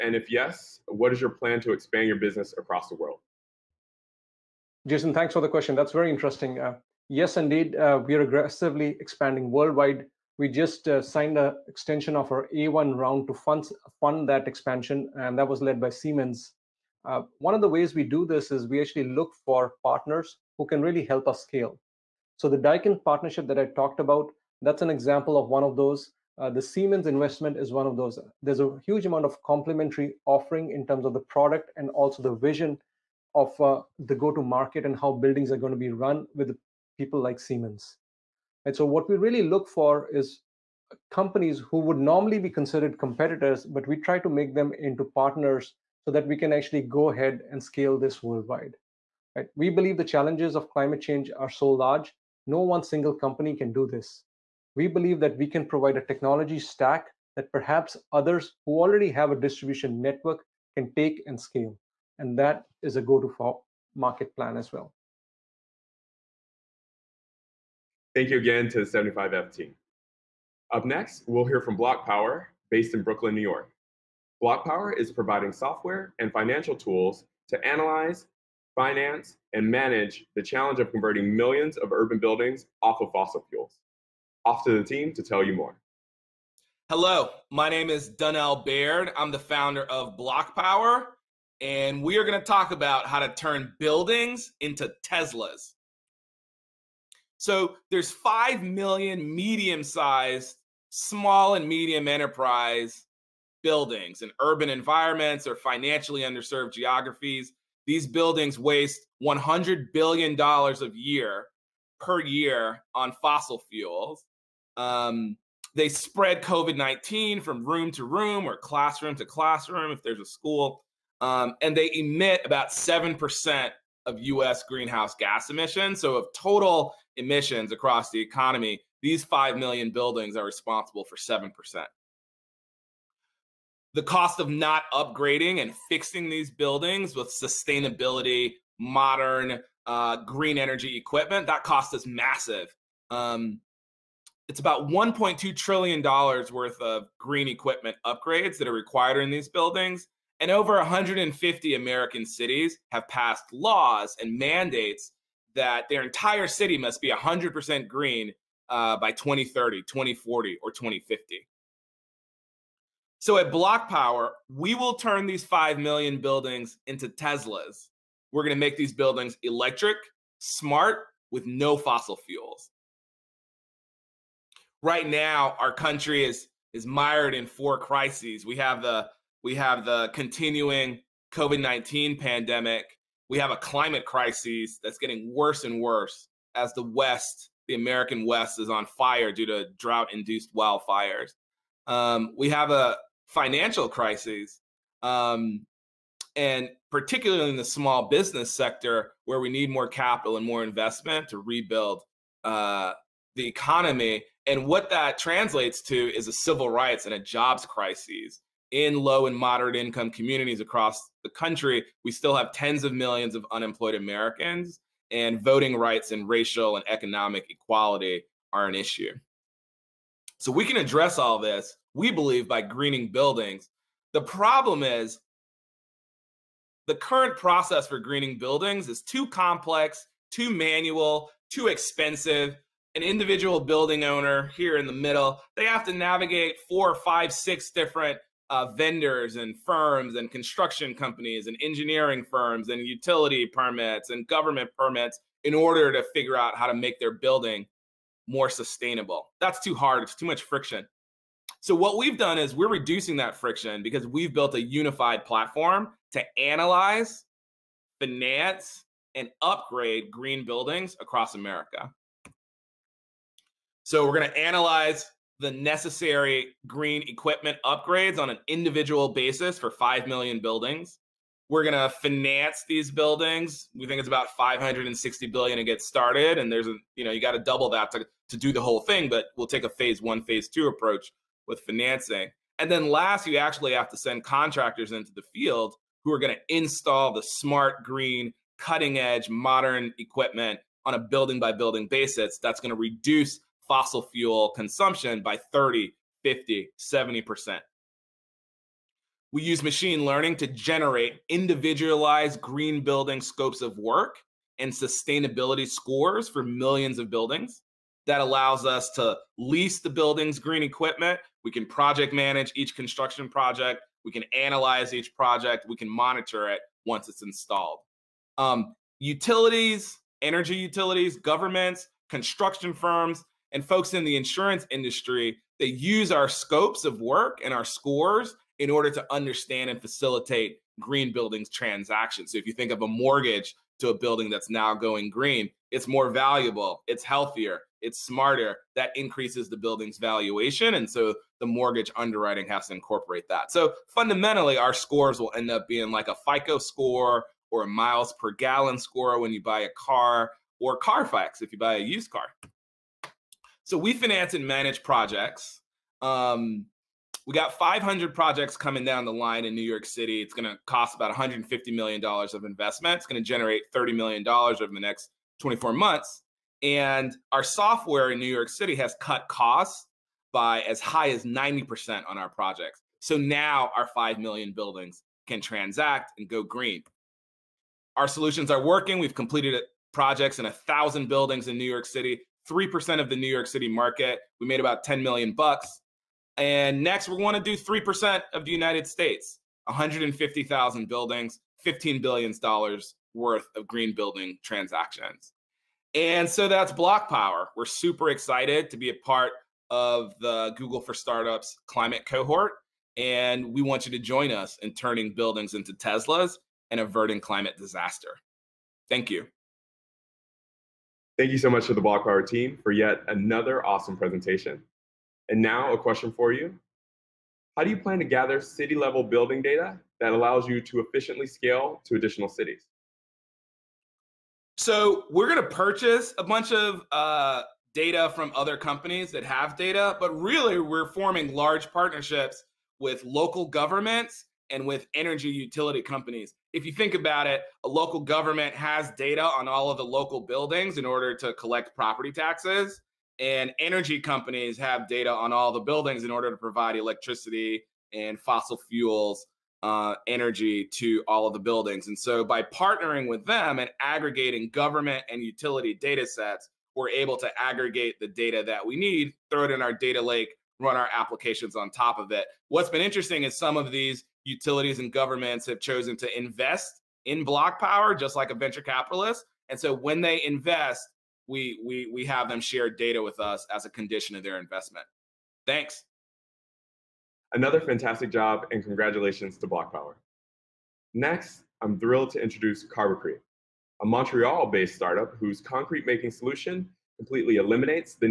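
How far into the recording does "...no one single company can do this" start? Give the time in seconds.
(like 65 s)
52 s.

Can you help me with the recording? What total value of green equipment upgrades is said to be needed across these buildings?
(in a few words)
$1.2 trillion.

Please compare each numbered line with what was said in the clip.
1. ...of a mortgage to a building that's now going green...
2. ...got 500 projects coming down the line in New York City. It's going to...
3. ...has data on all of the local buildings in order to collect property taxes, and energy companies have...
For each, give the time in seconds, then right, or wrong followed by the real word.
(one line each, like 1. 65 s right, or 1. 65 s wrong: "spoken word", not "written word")
1. 332 s right
2. 357 s right
3. 438 s right.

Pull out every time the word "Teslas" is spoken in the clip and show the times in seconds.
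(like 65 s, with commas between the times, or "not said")
95 s, 167 s, 405 s.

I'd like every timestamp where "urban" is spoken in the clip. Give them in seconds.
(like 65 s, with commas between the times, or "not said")
81 s, 104 s.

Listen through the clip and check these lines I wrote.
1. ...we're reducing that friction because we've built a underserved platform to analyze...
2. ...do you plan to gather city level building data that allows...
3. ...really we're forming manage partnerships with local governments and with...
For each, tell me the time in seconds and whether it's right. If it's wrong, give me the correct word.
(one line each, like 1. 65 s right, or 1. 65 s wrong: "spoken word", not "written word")
1. 252 s wrong: "unified", not "underserved"
2. 417 s right
3. 430 s wrong: "large", not "manage".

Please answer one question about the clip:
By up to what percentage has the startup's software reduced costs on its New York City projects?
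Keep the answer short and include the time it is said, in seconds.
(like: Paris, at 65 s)
90%, at 371 s.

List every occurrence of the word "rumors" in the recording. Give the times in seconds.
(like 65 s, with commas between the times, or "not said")
not said.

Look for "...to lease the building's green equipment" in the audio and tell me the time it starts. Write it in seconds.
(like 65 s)
308 s.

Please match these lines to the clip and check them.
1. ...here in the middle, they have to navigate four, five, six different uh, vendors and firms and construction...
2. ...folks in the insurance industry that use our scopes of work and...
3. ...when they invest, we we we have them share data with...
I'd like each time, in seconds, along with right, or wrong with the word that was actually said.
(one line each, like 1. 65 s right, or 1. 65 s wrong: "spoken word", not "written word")
1. 234 s right
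2. 323 s right
3. 469 s right.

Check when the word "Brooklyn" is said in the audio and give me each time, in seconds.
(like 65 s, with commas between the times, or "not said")
73 s.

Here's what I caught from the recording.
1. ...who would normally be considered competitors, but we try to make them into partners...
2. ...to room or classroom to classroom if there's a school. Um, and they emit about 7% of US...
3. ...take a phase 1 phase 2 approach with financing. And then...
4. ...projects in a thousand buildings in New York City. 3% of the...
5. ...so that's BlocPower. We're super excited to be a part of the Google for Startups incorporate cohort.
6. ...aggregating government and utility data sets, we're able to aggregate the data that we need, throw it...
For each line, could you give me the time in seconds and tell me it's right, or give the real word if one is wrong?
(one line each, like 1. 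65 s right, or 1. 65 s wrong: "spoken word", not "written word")
1. 41 s right
2. 117 s right
3. 279 s right
4. 379 s right
5. 396 s wrong: "climate", not "incorporate"
6. 453 s right.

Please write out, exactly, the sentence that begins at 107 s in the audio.
These buildings waste $100 billion a year per year on fossil fuels.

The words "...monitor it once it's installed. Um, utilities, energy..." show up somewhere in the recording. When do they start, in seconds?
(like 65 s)
315 s.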